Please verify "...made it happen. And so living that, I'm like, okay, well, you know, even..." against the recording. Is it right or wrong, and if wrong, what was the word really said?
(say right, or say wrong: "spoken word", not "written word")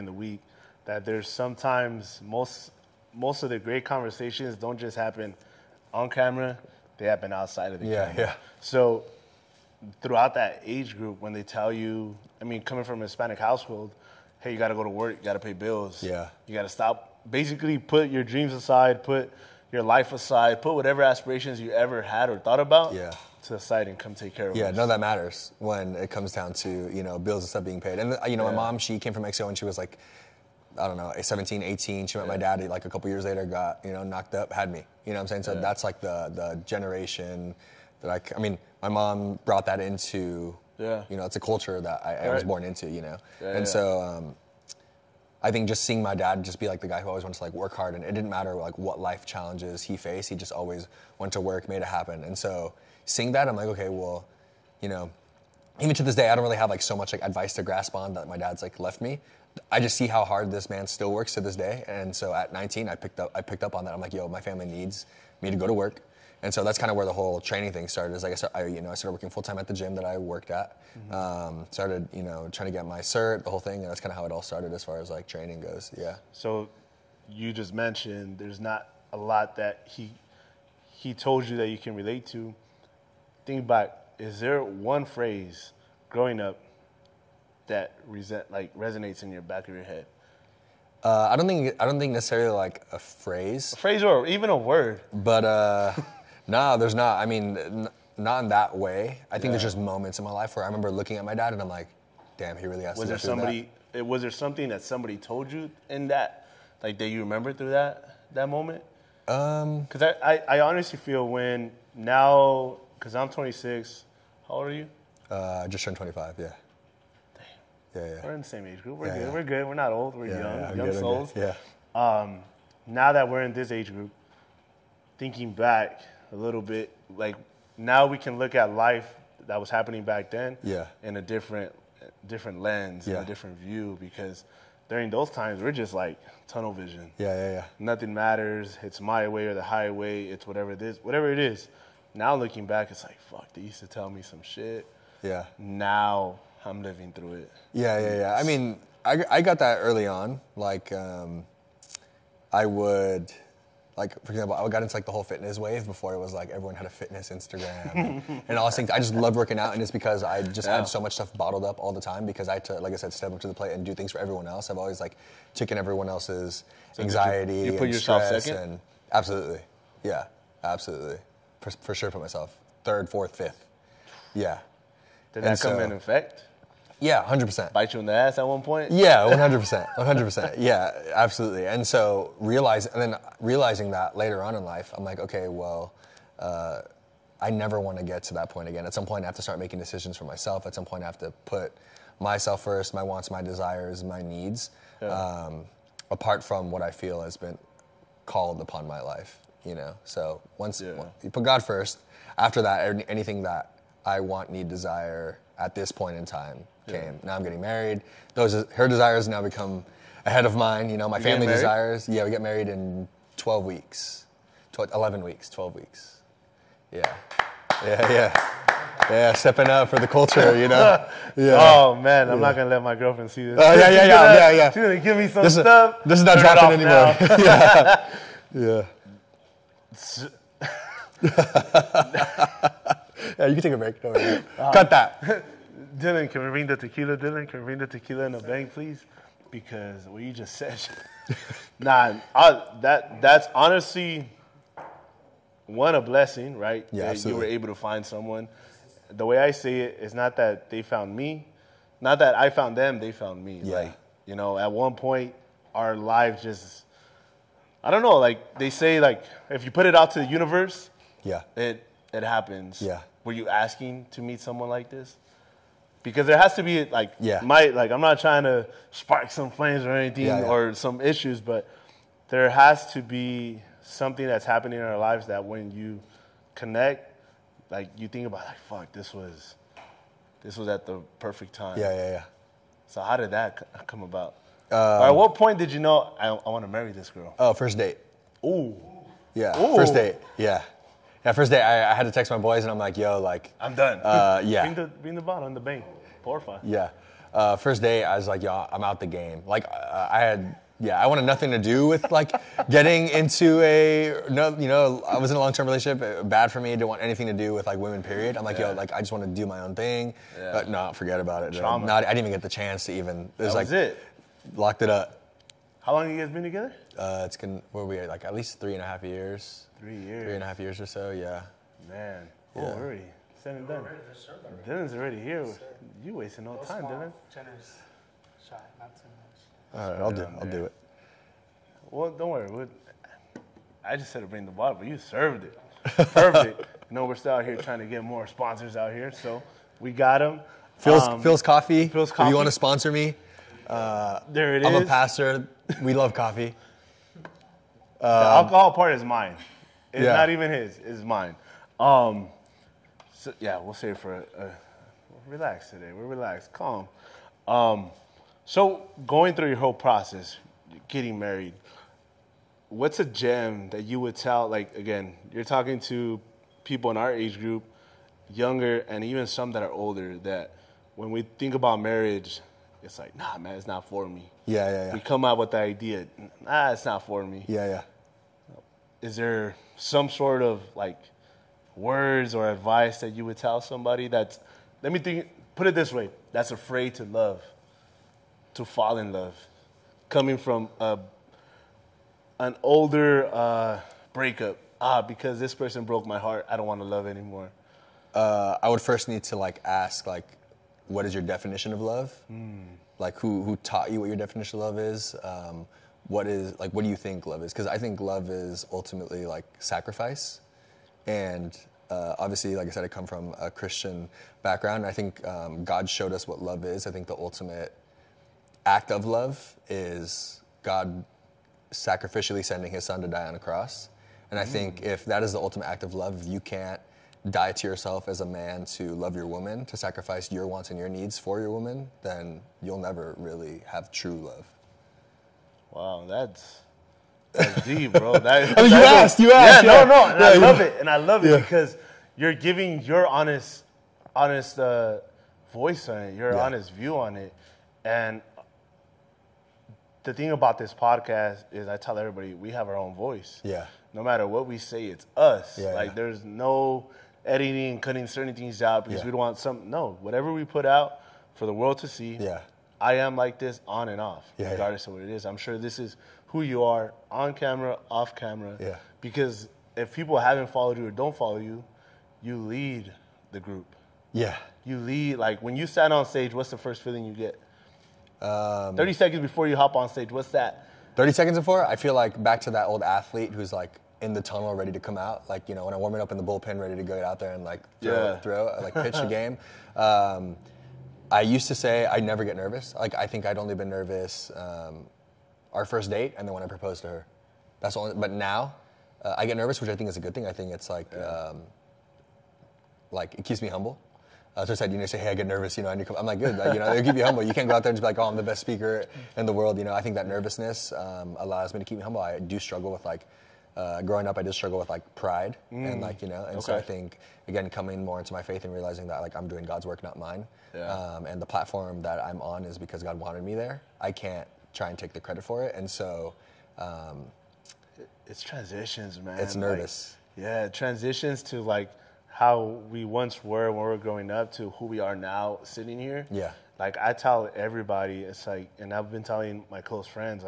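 wrong: "seeing", not "living".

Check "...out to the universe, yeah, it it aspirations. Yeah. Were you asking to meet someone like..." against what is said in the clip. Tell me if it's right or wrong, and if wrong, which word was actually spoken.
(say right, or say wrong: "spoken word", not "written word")
wrong: "happens", not "aspirations".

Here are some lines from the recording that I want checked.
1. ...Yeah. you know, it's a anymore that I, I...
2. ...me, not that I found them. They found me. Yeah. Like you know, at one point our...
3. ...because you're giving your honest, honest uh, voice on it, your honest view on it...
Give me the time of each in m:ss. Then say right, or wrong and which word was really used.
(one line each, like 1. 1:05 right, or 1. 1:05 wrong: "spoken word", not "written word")
1. 0:40 wrong: "culture", not "anymore"
2. 4:11 right
3. 7:21 right.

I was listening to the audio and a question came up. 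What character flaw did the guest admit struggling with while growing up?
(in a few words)
Pride.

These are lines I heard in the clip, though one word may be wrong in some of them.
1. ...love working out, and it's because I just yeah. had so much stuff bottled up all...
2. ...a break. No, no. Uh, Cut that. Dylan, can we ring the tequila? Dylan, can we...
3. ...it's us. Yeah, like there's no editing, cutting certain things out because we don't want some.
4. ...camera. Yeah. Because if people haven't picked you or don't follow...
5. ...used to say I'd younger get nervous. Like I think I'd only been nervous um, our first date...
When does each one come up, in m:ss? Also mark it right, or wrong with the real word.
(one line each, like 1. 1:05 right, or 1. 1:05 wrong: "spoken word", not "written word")
1. 2:39 right
2. 3:53 right
3. 7:34 right
4. 7:48 wrong: "followed", not "picked"
5. 8:11 wrong: "never", not "younger".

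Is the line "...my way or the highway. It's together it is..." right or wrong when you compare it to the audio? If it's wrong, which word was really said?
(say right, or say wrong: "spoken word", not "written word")
wrong: "whatever", not "together".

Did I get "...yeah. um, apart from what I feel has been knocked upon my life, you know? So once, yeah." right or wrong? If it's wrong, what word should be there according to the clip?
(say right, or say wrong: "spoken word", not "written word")
wrong: "called", not "knocked".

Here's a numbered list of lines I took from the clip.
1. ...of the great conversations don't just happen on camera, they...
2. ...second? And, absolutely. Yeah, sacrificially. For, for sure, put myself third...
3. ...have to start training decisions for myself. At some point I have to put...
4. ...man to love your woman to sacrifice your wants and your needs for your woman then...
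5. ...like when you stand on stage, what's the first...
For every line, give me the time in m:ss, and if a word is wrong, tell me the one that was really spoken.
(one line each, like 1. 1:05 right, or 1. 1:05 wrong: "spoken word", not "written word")
1. 0:03 right
2. 2:48 wrong: "absolutely", not "sacrificially"
3. 3:09 wrong: "making", not "training"
4. 7:08 right
5. 7:55 right.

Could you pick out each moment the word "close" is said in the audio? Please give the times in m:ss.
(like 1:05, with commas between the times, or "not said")
8:59.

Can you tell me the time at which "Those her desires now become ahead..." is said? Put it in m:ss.
3:28.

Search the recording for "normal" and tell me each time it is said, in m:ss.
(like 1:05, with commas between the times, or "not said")
not said.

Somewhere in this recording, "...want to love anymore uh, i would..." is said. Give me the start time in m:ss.
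6:36.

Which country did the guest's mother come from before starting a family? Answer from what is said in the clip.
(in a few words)
Mexico.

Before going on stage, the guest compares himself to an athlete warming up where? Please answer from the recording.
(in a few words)
In the bullpen.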